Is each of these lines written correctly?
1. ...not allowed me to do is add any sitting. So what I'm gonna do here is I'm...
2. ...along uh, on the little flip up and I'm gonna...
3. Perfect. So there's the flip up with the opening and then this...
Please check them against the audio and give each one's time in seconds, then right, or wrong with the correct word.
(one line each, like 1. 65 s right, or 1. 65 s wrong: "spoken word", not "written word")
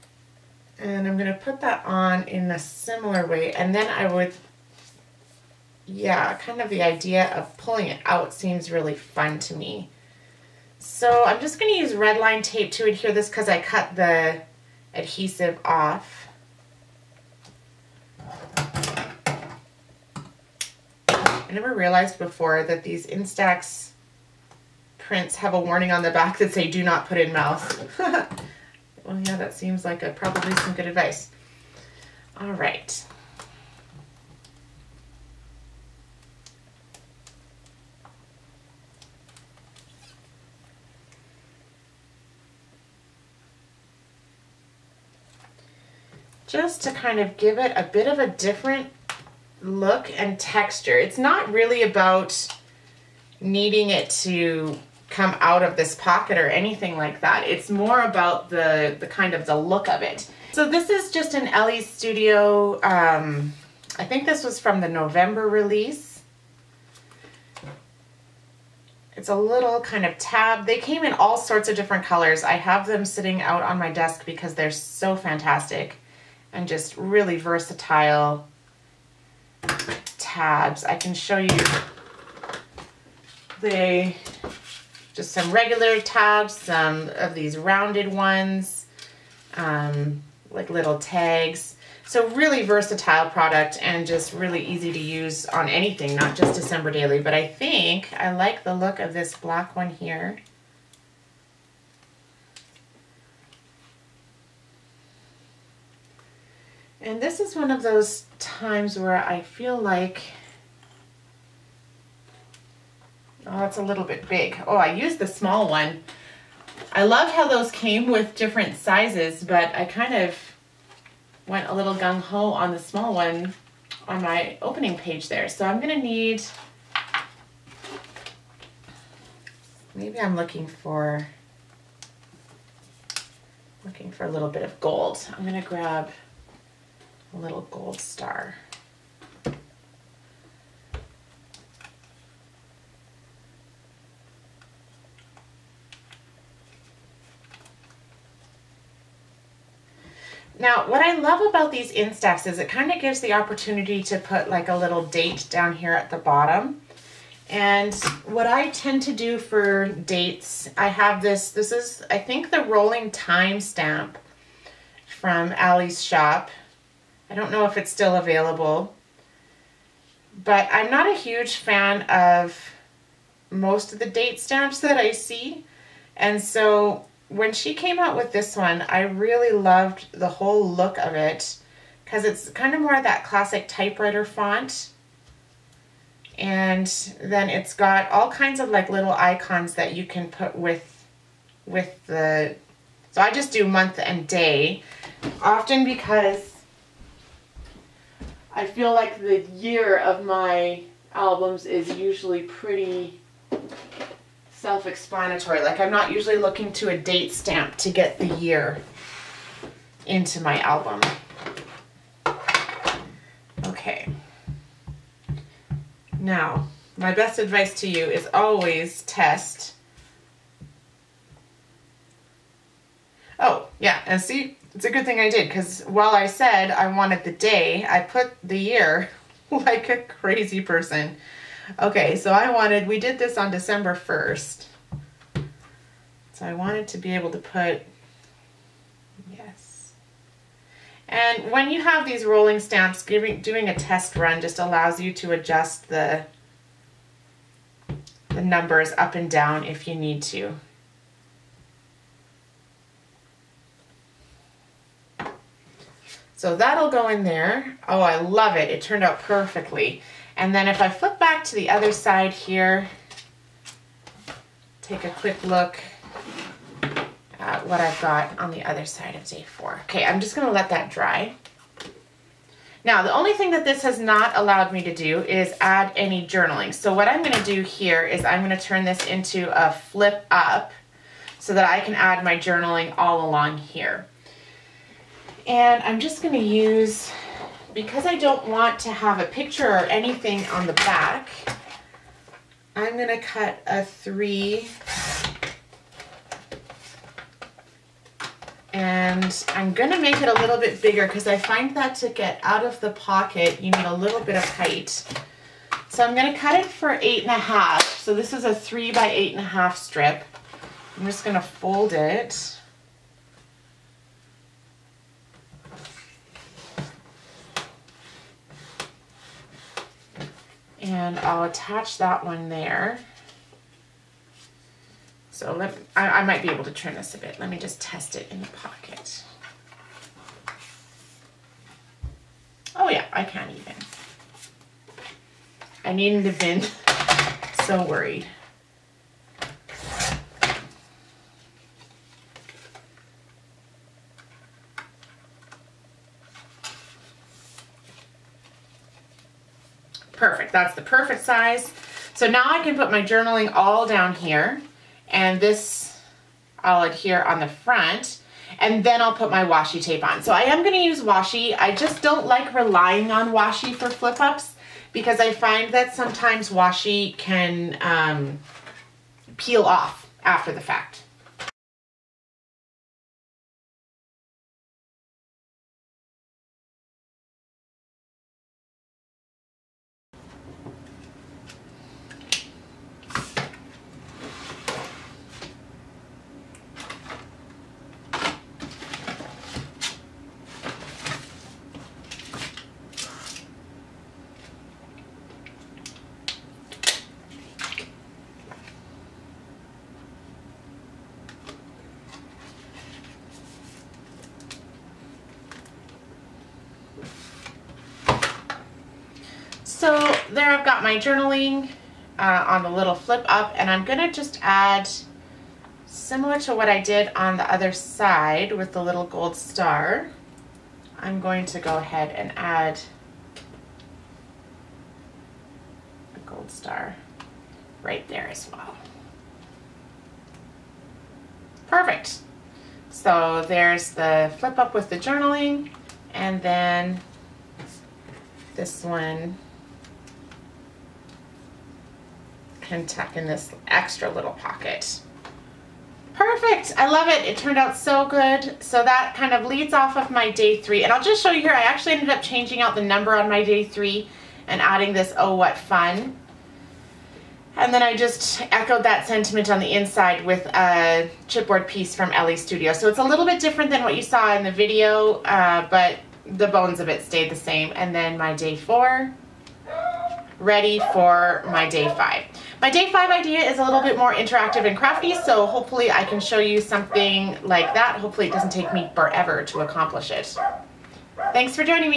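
1. 273 s wrong: "journaling", not "sitting"
2. 410 s wrong: "journaling", not "along"
3. 431 s wrong: "journaling", not "opening".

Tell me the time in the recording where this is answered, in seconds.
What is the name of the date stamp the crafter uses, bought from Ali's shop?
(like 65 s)
162 s.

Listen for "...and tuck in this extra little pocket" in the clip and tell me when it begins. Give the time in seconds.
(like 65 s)
442 s.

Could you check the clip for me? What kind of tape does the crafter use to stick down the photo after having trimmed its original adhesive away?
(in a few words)
red line tape.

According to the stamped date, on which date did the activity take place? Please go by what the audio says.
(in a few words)
December 1.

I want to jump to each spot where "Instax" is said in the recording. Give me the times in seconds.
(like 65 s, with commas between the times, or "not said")
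23 s, 151 s.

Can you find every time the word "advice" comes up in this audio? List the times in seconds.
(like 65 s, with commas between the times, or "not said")
30 s, 217 s.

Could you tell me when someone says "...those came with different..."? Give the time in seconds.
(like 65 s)
117 s.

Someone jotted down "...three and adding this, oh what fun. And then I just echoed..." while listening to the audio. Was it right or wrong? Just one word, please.
right.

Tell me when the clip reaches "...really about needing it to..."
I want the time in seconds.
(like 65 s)
51 s.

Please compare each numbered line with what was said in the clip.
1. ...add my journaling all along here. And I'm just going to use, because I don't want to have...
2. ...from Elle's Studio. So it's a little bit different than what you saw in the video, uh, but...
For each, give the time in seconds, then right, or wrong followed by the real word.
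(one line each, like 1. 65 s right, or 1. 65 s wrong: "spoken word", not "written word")
1. 281 s right
2. 461 s right.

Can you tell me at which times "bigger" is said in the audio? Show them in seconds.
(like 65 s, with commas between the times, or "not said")
300 s.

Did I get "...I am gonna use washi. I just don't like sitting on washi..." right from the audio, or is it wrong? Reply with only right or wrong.
wrong.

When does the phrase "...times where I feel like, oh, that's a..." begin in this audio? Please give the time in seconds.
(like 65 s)
108 s.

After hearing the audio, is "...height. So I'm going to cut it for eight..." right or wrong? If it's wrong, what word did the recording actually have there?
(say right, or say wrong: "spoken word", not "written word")
right.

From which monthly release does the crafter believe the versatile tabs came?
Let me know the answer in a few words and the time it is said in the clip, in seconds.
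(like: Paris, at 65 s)
November, at 64 s.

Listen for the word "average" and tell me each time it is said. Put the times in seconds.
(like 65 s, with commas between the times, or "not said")
not said.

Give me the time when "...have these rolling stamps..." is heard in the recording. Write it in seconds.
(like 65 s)
241 s.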